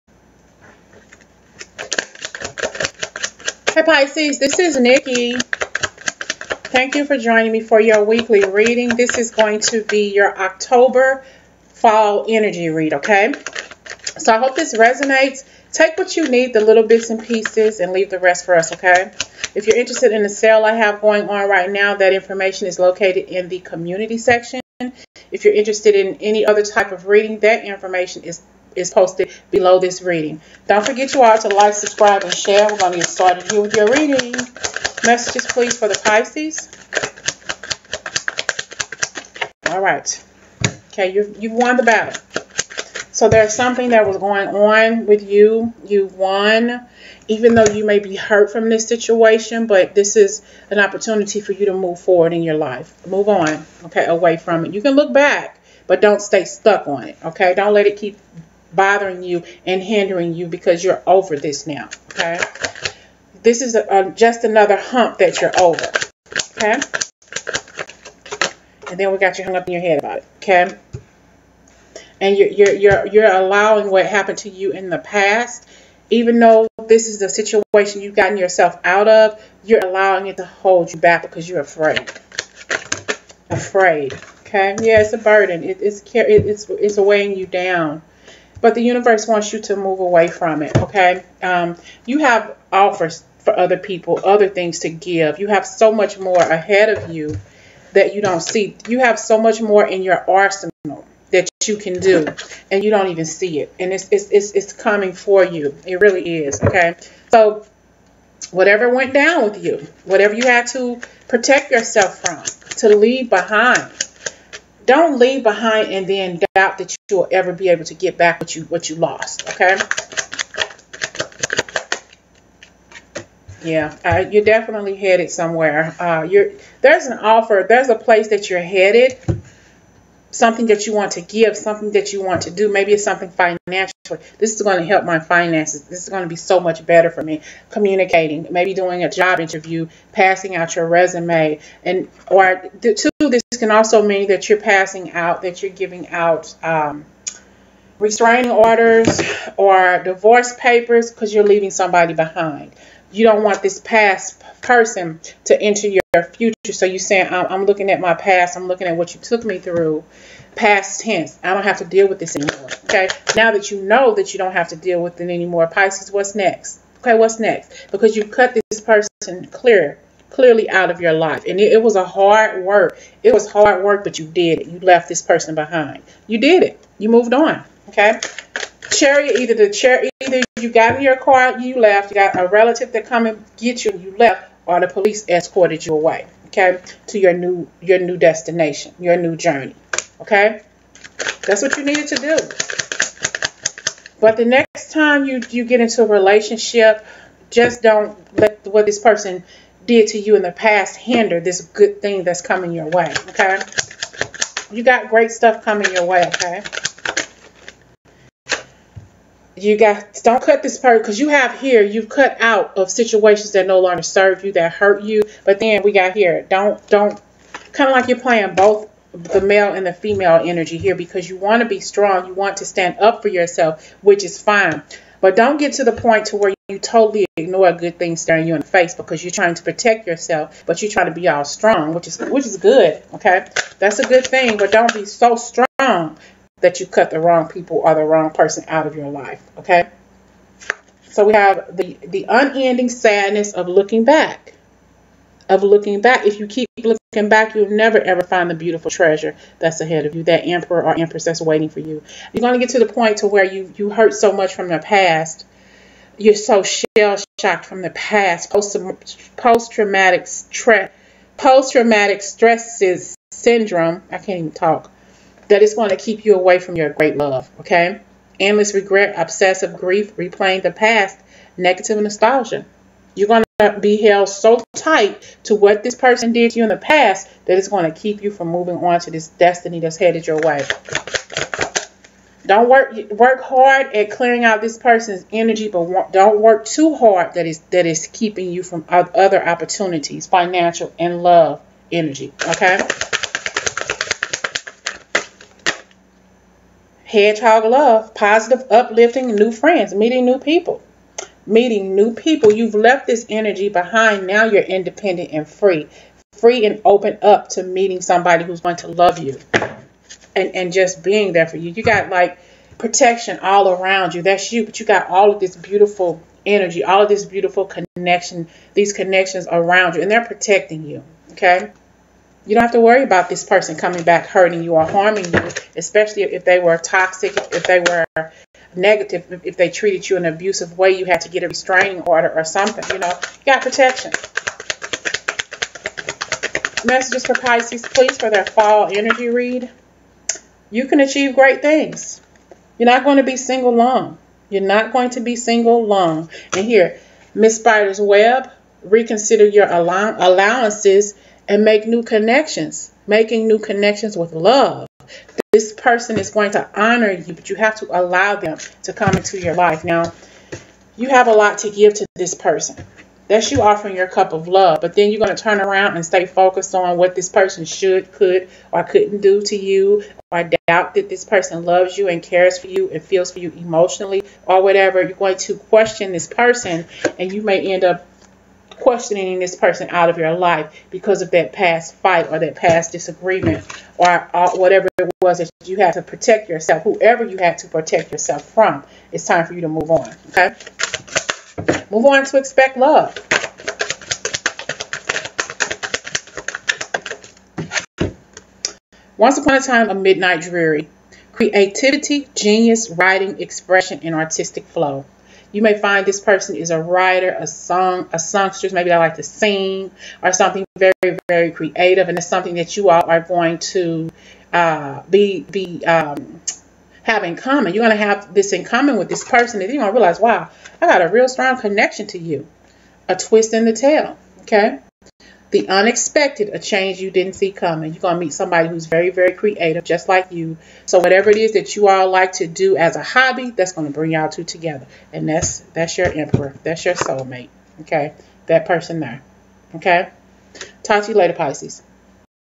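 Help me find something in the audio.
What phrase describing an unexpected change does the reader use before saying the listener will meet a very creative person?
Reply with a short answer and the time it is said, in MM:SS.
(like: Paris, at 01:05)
A twist in the tail, at 07:03.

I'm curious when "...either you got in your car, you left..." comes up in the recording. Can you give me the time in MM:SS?
03:00.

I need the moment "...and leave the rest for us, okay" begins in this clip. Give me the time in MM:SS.
00:17.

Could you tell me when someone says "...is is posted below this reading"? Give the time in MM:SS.
00:28.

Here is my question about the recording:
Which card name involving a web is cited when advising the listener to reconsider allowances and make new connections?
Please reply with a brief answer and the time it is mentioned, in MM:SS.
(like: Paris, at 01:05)
Miss Spider's Web, at 05:47.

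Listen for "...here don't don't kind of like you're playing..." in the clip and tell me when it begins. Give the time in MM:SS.
03:36.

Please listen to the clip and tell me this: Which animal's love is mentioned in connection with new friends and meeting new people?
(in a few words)
Hedgehog.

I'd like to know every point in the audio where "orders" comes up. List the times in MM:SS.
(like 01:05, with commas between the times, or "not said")
02:28, 05:32.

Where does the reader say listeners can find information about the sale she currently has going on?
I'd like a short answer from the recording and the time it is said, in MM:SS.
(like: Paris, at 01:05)
Community section, at 00:23.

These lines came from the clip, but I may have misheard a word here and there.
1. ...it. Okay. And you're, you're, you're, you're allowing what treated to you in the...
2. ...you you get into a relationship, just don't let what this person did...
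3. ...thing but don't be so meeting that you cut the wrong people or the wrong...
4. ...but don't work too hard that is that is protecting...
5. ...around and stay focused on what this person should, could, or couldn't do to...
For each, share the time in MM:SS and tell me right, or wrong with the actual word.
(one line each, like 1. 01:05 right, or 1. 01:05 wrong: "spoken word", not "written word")
1. 01:10 wrong: "happened", not "treated"
2. 03:15 right
3. 03:54 wrong: "strong", not "meeting"
4. 04:45 wrong: "keeping", not "protecting"
5. 06:05 right.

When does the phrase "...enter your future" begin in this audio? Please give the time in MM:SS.
02:35.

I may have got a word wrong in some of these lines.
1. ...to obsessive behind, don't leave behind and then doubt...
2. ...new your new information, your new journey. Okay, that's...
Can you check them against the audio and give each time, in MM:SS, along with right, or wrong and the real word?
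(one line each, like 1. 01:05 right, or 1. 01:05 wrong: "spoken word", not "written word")
1. 01:52 wrong: "leave", not "obsessive"
2. 03:07 wrong: "destination", not "information".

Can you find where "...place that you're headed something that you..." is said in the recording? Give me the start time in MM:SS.
02:07.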